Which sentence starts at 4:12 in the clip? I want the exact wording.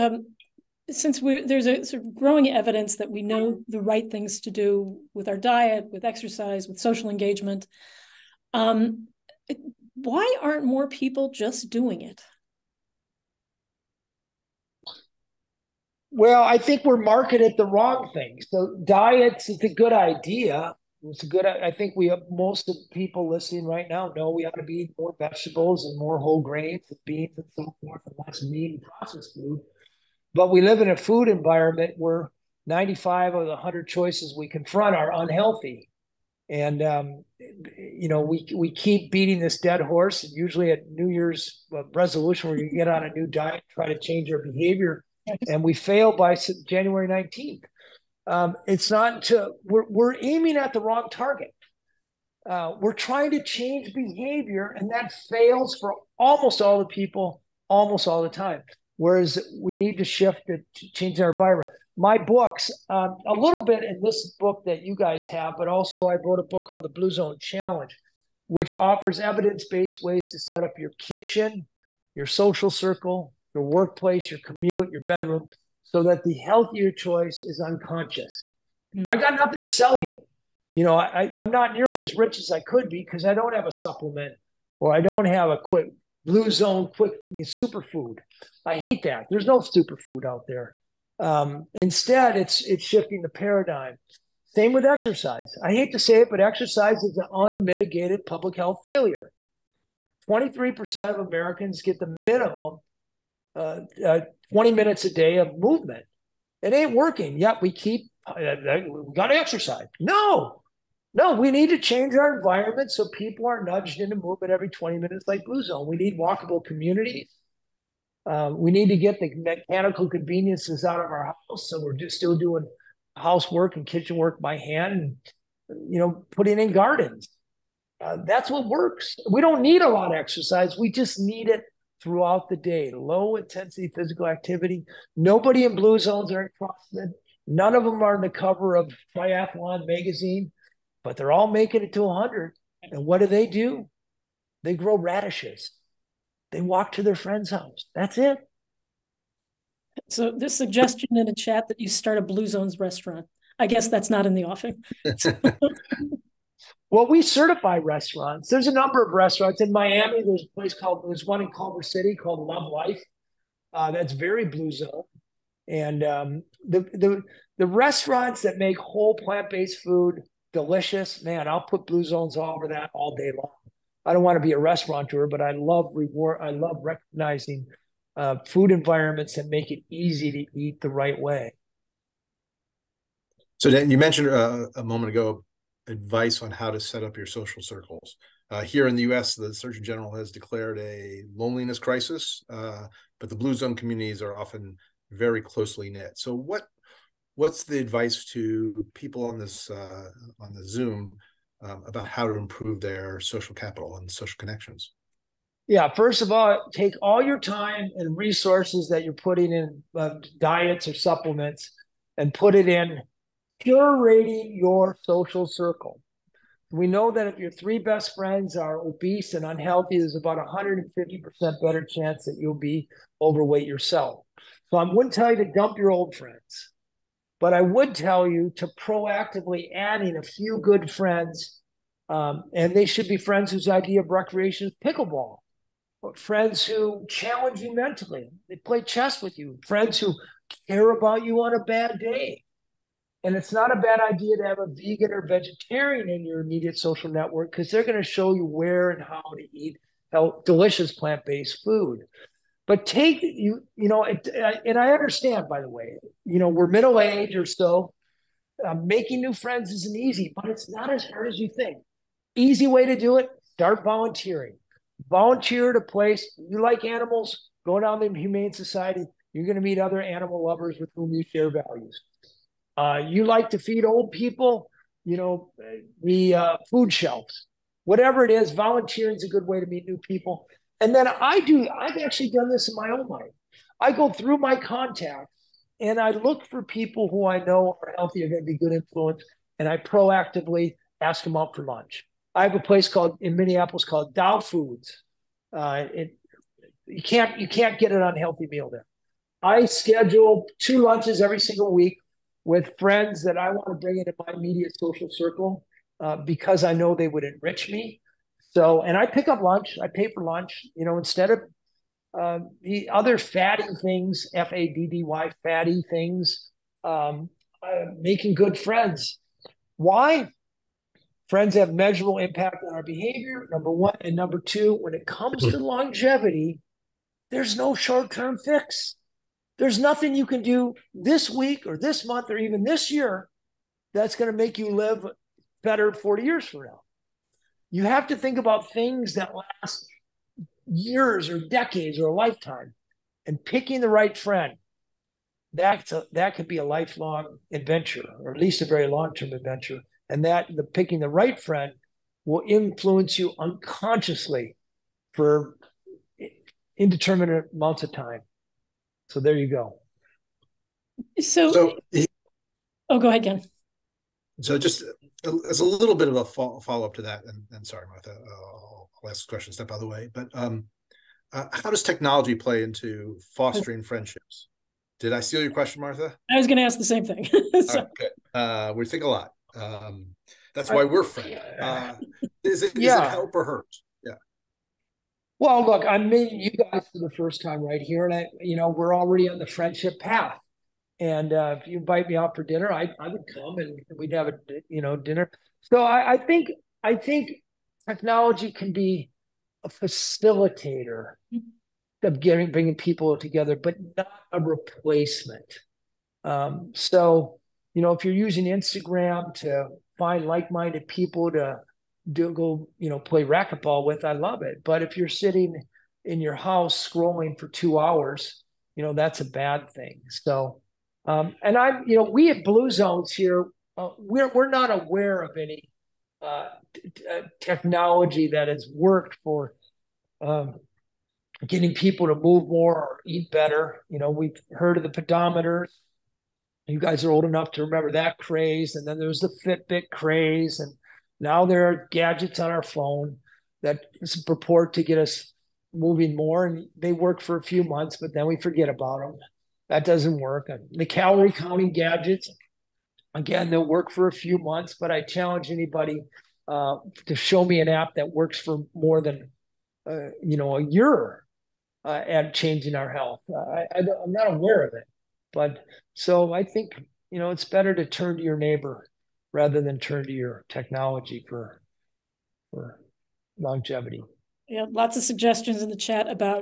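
But take you, you know, it, and I understand.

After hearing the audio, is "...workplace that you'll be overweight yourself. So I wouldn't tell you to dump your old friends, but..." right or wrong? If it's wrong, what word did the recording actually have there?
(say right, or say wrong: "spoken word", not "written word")
wrong: "chance", not "workplace".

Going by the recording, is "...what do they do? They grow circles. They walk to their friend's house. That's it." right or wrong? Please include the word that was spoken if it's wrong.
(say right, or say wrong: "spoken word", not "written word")
wrong: "radishes", not "circles".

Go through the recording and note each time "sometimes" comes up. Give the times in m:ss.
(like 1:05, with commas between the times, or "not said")
not said.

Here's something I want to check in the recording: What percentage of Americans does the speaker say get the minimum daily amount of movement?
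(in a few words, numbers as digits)
23%.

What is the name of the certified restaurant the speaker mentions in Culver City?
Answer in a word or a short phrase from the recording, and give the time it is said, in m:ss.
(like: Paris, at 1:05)
Love Life, at 2:42.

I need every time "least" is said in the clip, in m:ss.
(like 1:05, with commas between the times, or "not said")
5:48.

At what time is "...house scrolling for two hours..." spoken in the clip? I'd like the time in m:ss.
6:56.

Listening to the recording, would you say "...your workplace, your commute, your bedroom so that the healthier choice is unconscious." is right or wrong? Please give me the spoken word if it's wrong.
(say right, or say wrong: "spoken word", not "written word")
right.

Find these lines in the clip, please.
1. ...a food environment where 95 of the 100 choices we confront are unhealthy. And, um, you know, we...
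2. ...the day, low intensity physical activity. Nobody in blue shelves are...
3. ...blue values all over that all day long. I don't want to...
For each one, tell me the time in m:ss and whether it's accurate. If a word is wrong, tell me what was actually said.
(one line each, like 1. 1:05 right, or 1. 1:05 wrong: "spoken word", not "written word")
1. 0:30 right
2. 2:12 wrong: "zones", not "shelves"
3. 2:51 wrong: "zones", not "values".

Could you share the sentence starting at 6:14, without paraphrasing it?
Did I steal your question, Martha?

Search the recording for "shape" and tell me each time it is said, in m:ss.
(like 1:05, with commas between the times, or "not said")
not said.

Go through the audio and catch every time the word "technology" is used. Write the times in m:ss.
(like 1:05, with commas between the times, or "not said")
6:11, 6:37, 7:07, 7:50.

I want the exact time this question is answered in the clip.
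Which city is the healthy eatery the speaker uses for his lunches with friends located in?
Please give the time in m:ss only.
4:53.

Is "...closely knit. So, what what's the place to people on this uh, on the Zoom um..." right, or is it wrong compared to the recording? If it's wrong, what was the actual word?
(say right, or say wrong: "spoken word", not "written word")
wrong: "advice", not "place".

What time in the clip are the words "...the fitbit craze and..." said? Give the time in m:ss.
7:19.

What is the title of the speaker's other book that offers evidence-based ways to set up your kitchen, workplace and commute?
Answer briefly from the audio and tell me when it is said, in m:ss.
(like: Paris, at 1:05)
The Blue Zone Challenge, at 1:06.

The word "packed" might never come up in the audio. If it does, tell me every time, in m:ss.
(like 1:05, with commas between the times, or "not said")
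not said.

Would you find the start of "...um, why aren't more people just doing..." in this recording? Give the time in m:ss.
0:08.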